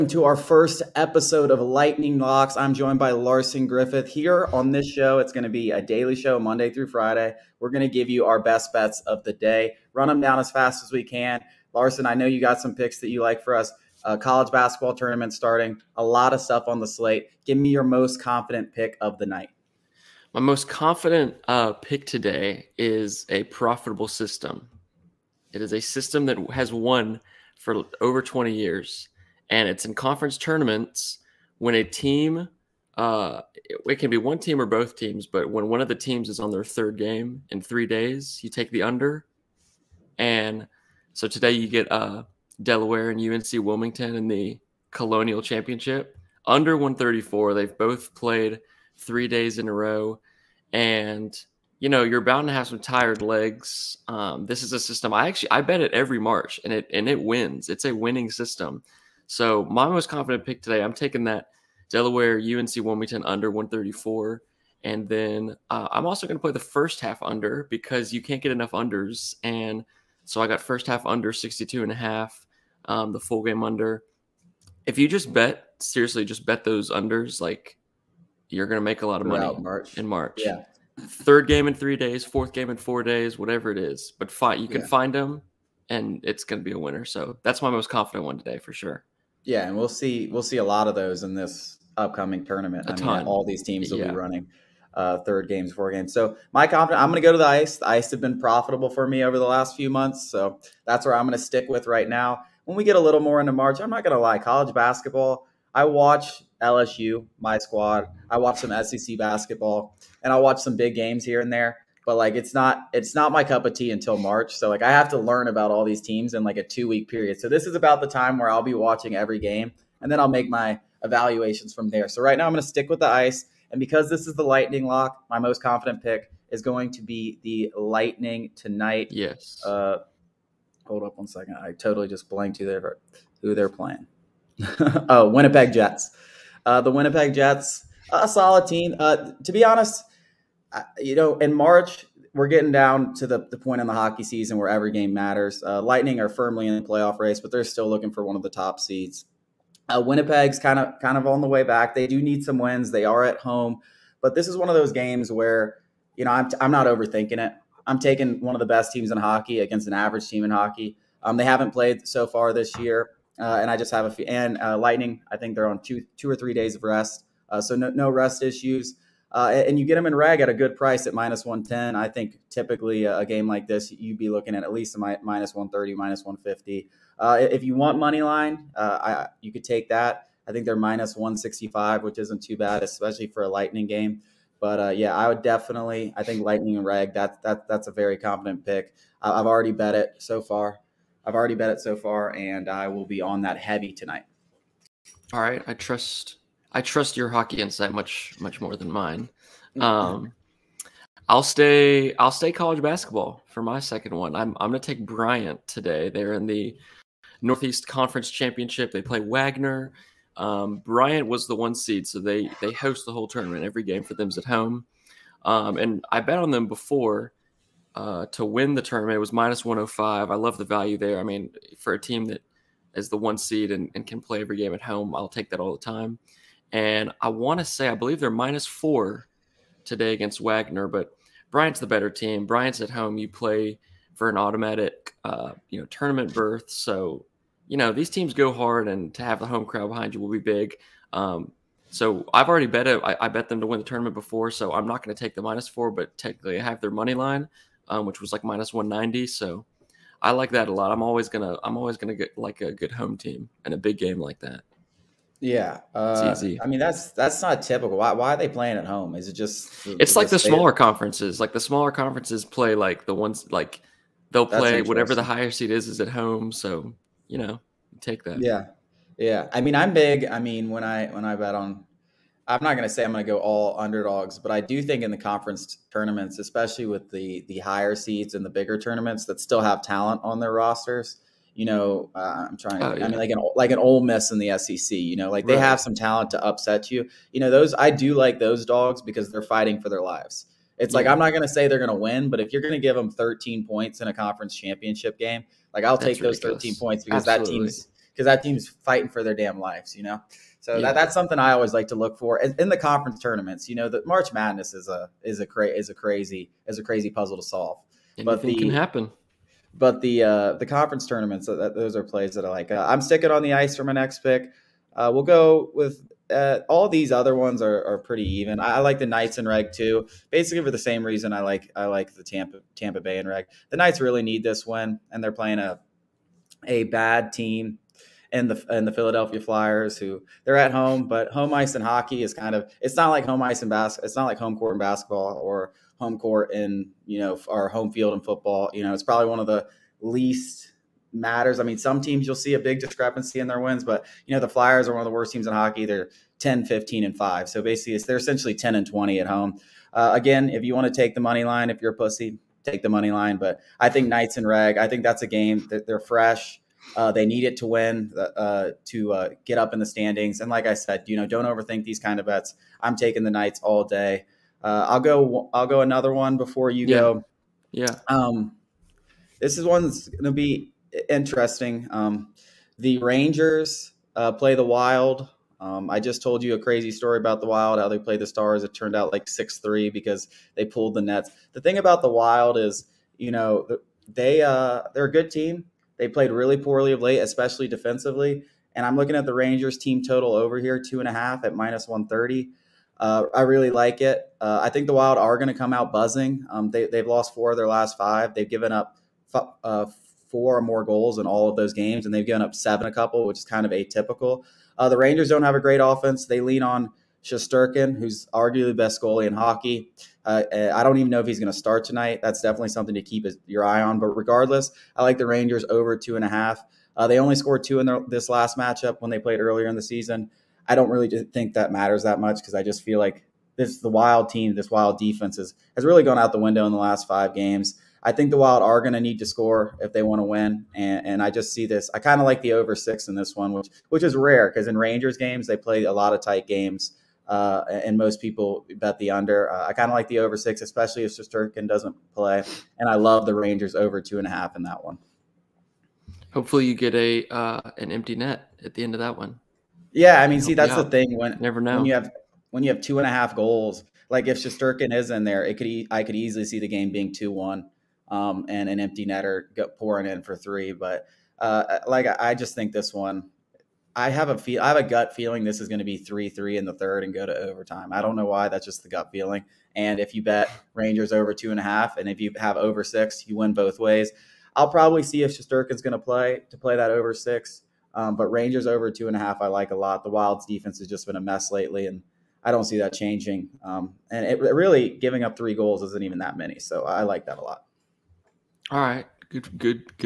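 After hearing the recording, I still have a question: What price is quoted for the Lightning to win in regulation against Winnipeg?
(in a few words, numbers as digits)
-110.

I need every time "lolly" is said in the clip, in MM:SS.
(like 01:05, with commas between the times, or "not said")
not said.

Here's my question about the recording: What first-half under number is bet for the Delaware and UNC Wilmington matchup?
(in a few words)
62.5.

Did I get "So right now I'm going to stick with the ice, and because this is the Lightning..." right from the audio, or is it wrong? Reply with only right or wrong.
right.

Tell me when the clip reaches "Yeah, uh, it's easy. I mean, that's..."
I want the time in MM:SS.
04:15.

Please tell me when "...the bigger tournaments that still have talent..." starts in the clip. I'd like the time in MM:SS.
04:38.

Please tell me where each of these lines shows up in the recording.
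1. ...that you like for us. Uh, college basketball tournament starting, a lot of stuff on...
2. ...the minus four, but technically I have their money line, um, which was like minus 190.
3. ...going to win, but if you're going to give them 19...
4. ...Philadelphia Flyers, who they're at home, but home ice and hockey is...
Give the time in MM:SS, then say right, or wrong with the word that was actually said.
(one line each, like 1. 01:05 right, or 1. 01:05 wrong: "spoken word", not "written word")
1. 00:12 right
2. 04:05 right
3. 04:51 wrong: "13", not "19"
4. 05:28 right.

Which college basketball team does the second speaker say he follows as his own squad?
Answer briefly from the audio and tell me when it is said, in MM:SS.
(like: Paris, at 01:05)
LSU, at 01:46.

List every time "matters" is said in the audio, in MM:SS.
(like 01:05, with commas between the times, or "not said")
02:25, 05:41, 07:01.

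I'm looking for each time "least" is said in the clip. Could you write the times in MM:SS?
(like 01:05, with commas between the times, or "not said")
02:54, 05:40.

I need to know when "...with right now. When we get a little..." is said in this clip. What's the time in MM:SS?
01:41.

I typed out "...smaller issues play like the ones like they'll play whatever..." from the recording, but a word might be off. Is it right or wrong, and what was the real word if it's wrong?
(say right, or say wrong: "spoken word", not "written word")
wrong: "conferences", not "issues".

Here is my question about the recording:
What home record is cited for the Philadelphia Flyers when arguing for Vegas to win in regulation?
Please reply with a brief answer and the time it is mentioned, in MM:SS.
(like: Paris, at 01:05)
10-15-5, at 05:46.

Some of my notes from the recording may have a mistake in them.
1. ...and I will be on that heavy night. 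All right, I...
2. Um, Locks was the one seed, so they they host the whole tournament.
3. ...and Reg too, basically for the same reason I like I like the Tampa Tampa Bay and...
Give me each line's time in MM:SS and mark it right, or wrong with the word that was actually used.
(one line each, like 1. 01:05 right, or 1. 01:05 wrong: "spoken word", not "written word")
1. 03:12 wrong: "tonight", not "night"
2. 03:30 wrong: "Bryant", not "Locks"
3. 05:19 right.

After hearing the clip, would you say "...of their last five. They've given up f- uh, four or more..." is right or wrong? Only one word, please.
right.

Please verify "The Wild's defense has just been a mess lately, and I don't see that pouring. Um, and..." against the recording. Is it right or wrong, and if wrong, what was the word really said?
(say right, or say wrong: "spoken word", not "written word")
wrong: "changing", not "pouring".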